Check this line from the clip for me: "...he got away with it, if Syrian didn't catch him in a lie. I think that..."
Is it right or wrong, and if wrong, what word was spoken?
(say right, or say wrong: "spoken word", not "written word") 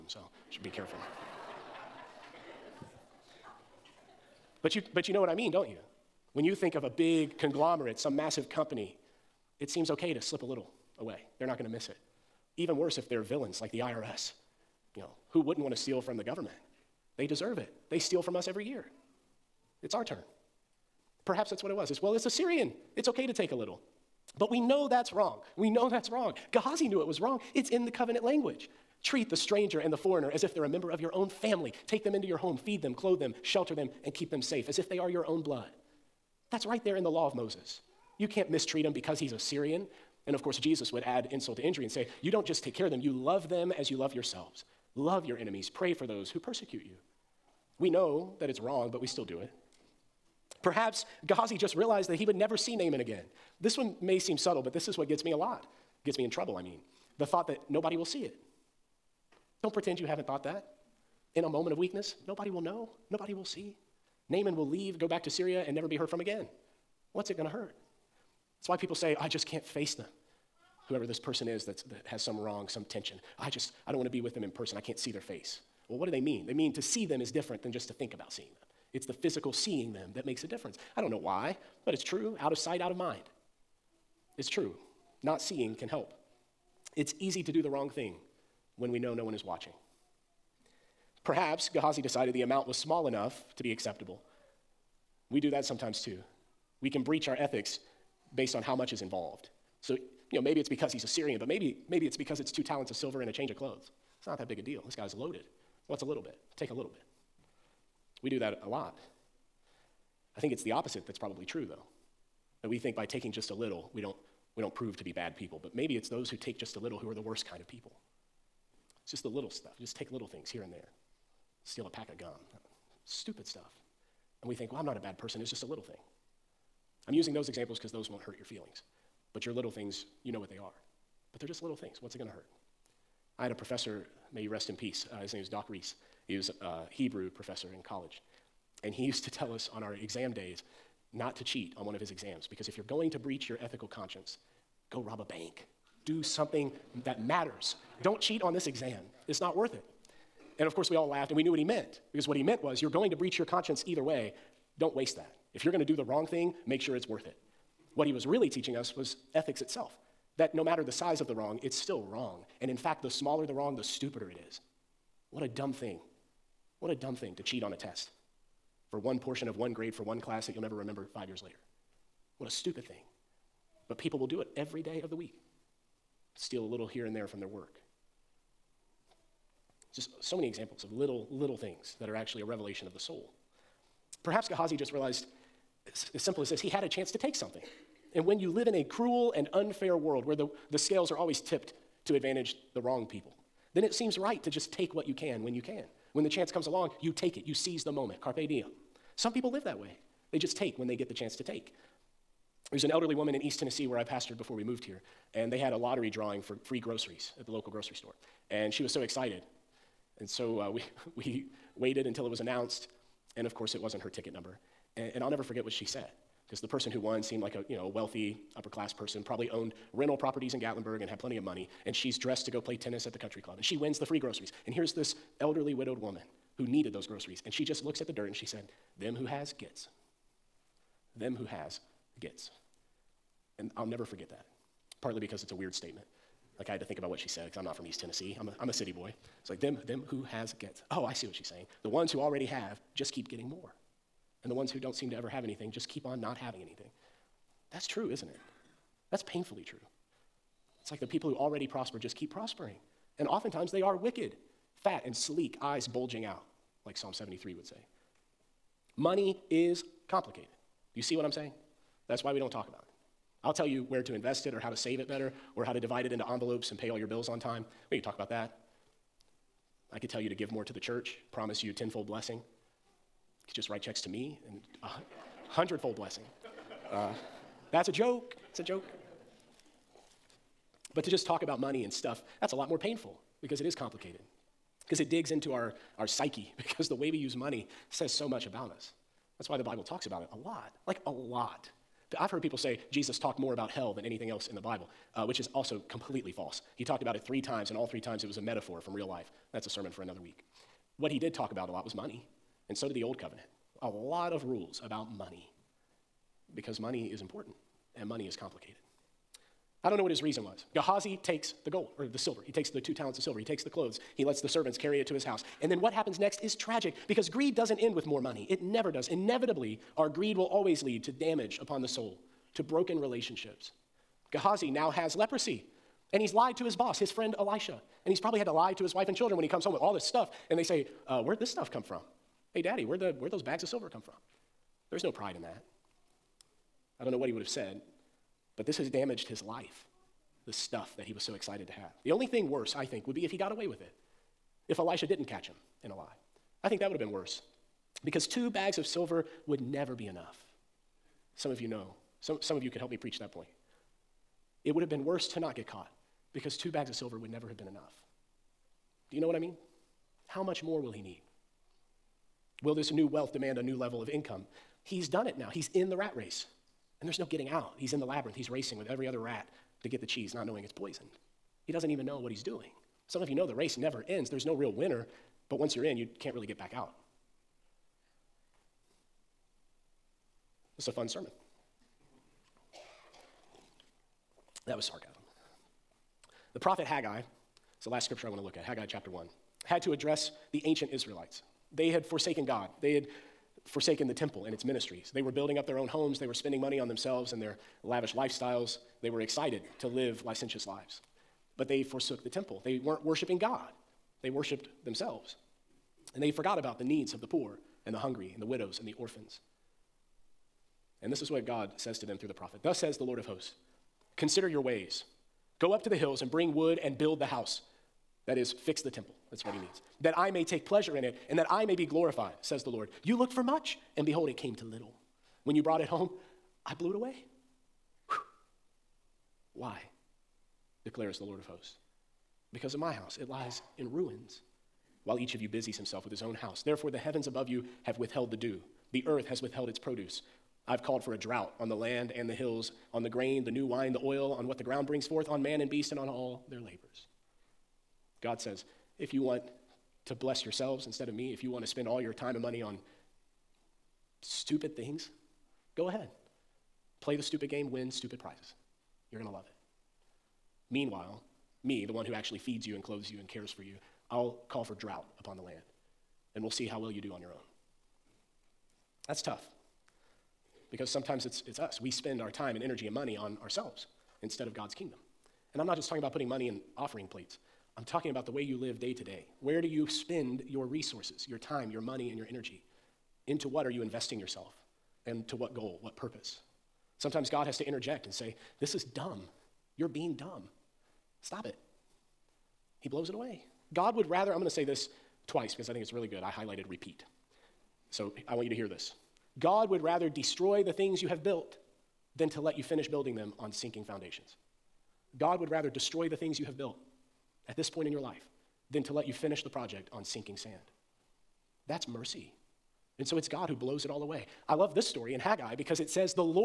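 wrong: "Elisha", not "Syrian".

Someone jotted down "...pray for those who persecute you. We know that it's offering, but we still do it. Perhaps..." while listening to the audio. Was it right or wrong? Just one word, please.
wrong.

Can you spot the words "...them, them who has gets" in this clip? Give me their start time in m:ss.
3:59.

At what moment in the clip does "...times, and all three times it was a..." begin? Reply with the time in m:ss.
4:57.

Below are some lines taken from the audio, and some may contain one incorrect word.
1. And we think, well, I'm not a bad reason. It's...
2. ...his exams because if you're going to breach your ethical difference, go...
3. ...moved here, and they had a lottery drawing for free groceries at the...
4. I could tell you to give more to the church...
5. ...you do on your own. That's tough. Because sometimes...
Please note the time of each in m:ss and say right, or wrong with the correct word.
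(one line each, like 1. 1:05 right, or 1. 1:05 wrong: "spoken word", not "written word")
1. 2:04 wrong: "person", not "reason"
2. 2:21 wrong: "conscience", not "difference"
3. 3:24 right
4. 4:29 right
5. 7:46 right.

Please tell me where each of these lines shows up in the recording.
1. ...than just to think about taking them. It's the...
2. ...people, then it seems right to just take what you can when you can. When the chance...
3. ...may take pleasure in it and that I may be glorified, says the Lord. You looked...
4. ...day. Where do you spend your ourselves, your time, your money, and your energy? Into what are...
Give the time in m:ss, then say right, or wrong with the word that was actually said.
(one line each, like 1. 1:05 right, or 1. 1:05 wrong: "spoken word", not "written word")
1. 1:17 wrong: "seeing", not "taking"
2. 3:13 right
3. 7:00 right
4. 7:59 wrong: "resources", not "ourselves".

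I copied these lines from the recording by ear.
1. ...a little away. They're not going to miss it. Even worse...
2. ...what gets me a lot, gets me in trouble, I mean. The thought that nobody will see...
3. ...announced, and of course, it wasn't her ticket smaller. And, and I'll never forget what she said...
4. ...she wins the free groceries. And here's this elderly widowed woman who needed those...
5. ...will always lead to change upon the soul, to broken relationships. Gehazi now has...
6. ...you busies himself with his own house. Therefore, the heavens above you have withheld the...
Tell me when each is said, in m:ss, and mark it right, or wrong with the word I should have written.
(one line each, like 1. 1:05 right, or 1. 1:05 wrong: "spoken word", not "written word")
1. 0:10 right
2. 0:54 right
3. 3:32 wrong: "number", not "smaller"
4. 3:43 right
5. 5:20 wrong: "damage", not "change"
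6. 7:15 right.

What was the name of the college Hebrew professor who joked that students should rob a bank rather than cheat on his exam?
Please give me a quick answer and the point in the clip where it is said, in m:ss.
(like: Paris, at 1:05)
Doc Reese, at 2:15.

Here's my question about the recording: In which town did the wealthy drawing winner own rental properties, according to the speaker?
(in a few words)
Gatlinburg.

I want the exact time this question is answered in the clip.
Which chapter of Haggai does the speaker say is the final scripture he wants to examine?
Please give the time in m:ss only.
6:28.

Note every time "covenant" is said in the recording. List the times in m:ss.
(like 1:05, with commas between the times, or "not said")
0:27, 5:03.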